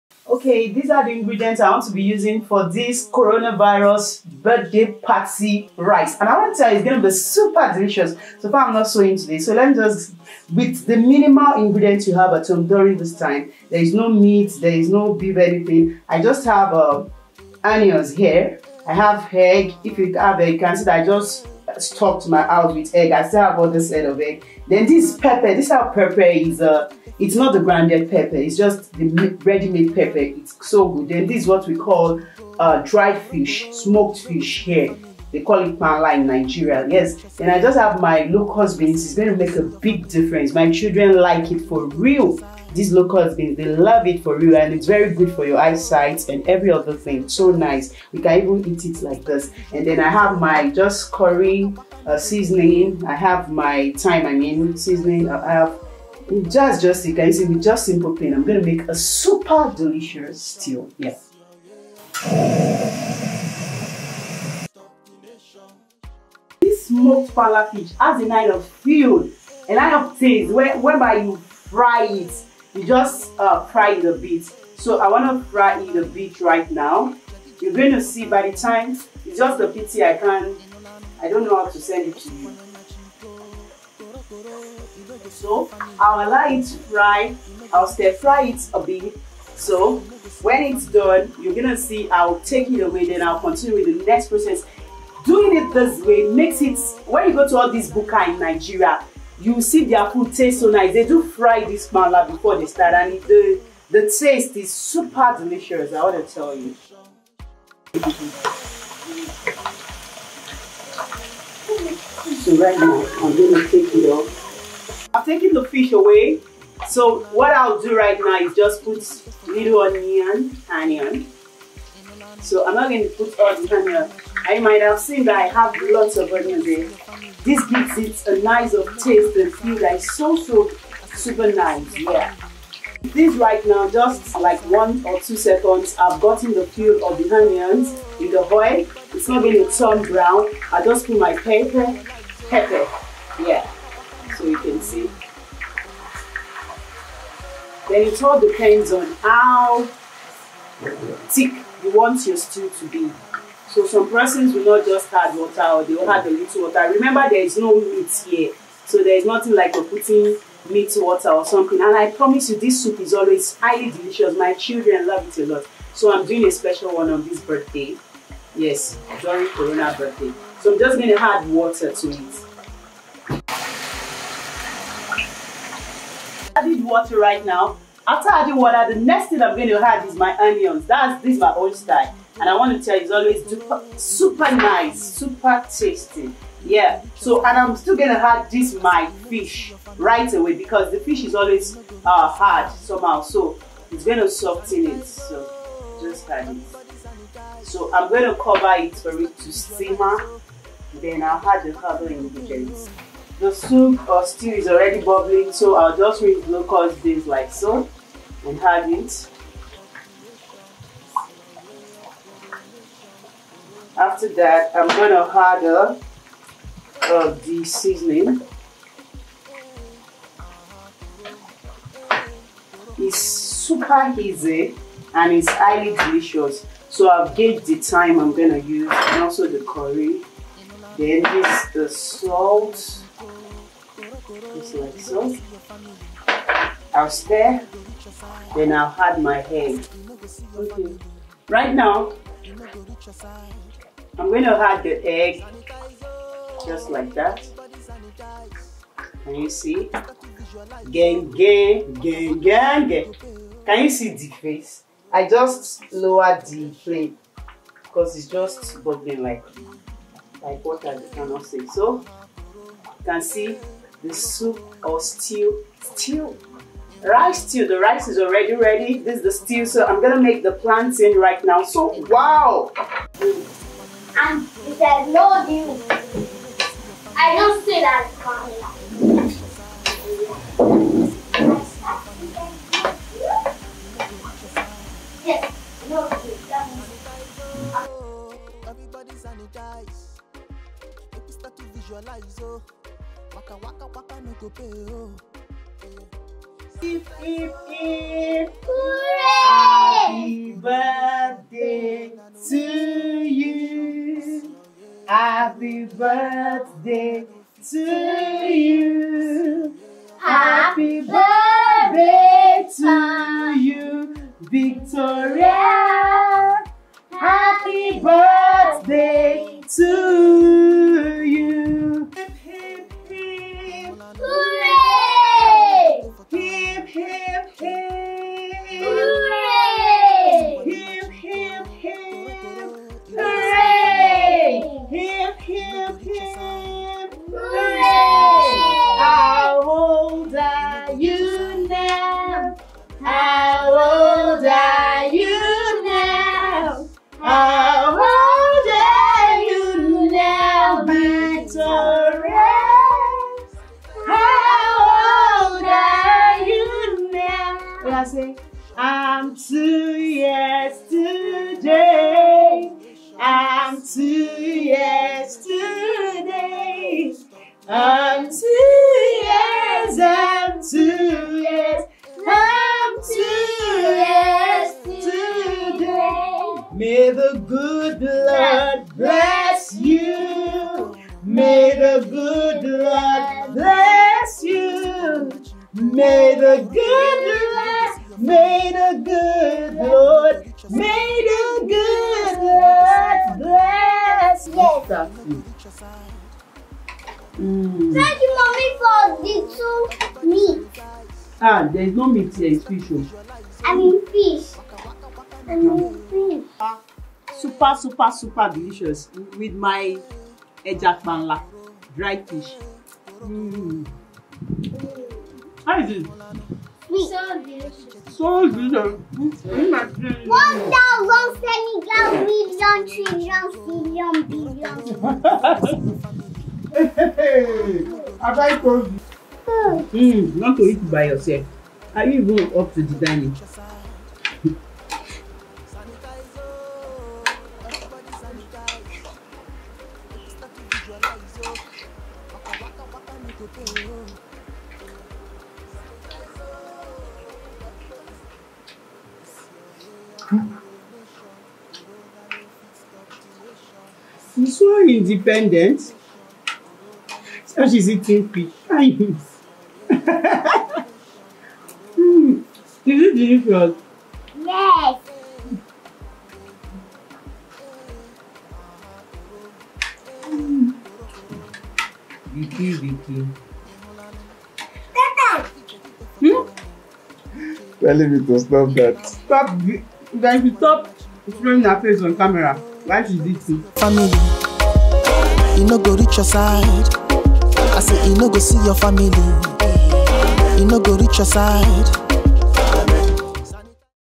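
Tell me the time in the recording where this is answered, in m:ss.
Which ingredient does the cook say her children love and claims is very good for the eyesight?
0:38.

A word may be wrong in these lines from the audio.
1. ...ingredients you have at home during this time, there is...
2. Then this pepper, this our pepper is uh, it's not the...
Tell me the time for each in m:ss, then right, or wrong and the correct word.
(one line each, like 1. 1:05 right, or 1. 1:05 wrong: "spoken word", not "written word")
1. 0:11 right
2. 0:24 right.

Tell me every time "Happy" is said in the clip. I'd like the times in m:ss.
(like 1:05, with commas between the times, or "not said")
4:56, 5:05.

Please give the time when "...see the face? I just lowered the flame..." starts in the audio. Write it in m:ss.
4:13.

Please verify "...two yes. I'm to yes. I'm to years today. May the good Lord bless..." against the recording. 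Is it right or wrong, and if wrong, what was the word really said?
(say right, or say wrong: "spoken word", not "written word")
right.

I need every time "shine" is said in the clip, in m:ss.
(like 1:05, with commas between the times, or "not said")
not said.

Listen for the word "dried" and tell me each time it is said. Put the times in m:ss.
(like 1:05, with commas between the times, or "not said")
0:32, 6:51.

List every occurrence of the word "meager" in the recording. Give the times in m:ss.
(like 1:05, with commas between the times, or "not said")
not said.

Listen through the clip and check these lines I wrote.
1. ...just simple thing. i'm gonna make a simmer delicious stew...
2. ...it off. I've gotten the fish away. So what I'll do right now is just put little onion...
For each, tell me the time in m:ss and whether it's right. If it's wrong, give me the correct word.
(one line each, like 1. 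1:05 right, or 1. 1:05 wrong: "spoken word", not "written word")
1. 0:57 wrong: "super", not "simmer"
2. 1:53 wrong: "taken", not "gotten".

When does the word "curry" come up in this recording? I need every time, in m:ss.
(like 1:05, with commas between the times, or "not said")
0:51, 3:49.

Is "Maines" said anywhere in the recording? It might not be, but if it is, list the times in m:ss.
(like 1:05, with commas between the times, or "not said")
not said.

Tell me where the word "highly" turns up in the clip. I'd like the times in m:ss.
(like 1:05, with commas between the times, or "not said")
2:43, 3:45.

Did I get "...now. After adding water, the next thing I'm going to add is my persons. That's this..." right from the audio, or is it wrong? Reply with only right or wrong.
wrong.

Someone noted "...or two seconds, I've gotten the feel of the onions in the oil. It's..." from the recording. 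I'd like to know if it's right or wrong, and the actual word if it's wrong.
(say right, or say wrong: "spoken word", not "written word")
right.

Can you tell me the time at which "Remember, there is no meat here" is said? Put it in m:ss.
2:36.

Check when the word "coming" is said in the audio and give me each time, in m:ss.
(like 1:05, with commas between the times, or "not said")
4:38.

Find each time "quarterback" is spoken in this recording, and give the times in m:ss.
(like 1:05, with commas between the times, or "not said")
not said.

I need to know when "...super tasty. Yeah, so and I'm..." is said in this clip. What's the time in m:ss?
3:05.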